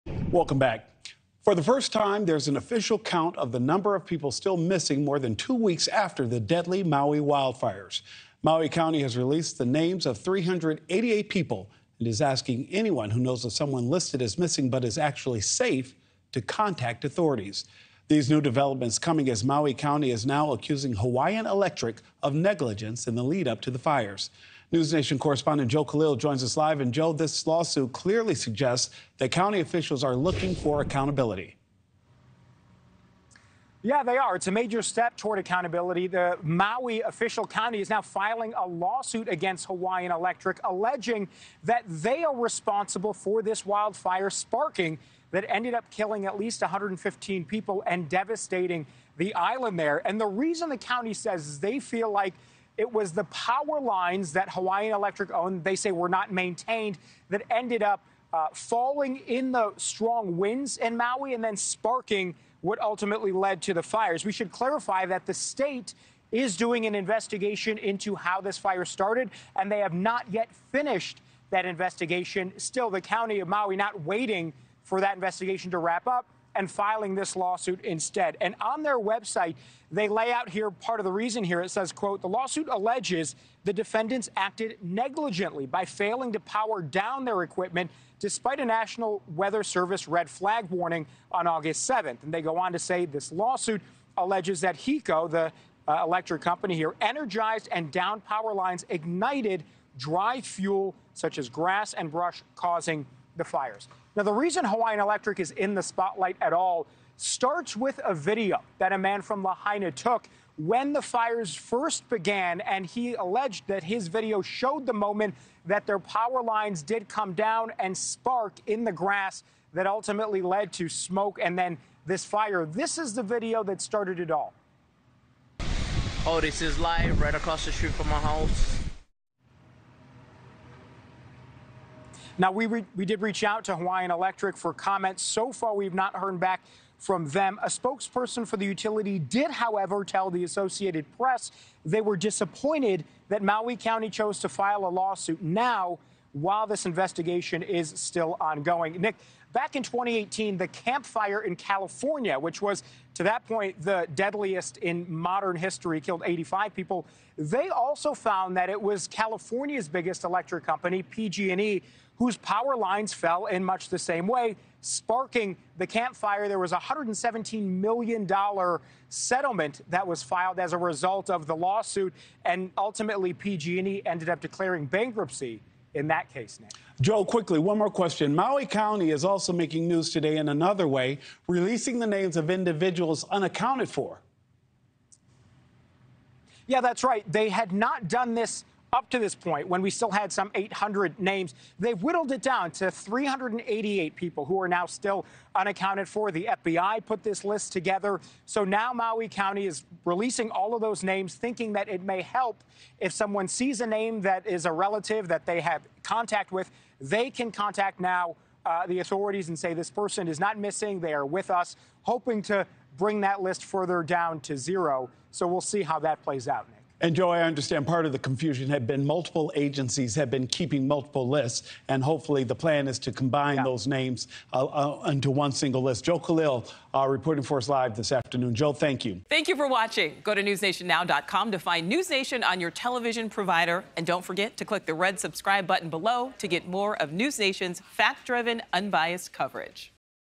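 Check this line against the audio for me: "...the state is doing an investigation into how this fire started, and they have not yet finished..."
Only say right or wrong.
right.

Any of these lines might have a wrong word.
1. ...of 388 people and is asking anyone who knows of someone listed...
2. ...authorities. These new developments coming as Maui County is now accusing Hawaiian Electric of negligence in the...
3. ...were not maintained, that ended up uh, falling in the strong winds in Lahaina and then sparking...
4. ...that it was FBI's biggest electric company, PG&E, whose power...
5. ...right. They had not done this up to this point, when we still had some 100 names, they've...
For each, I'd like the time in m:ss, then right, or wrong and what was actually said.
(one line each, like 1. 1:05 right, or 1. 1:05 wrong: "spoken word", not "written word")
1. 0:10 right
2. 0:17 right
3. 0:55 wrong: "Maui", not "Lahaina"
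4. 2:38 wrong: "California", not "FBI"
5. 3:07 wrong: "800", not "100".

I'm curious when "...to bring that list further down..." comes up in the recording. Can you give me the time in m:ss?
3:32.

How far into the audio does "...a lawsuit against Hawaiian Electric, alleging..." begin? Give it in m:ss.
0:38.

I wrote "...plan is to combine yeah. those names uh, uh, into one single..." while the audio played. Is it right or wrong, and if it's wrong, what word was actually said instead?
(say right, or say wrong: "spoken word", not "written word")
right.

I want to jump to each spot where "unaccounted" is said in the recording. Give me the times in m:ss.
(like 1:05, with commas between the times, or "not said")
3:03, 3:15.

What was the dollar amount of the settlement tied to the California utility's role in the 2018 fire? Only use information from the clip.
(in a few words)
$117 million.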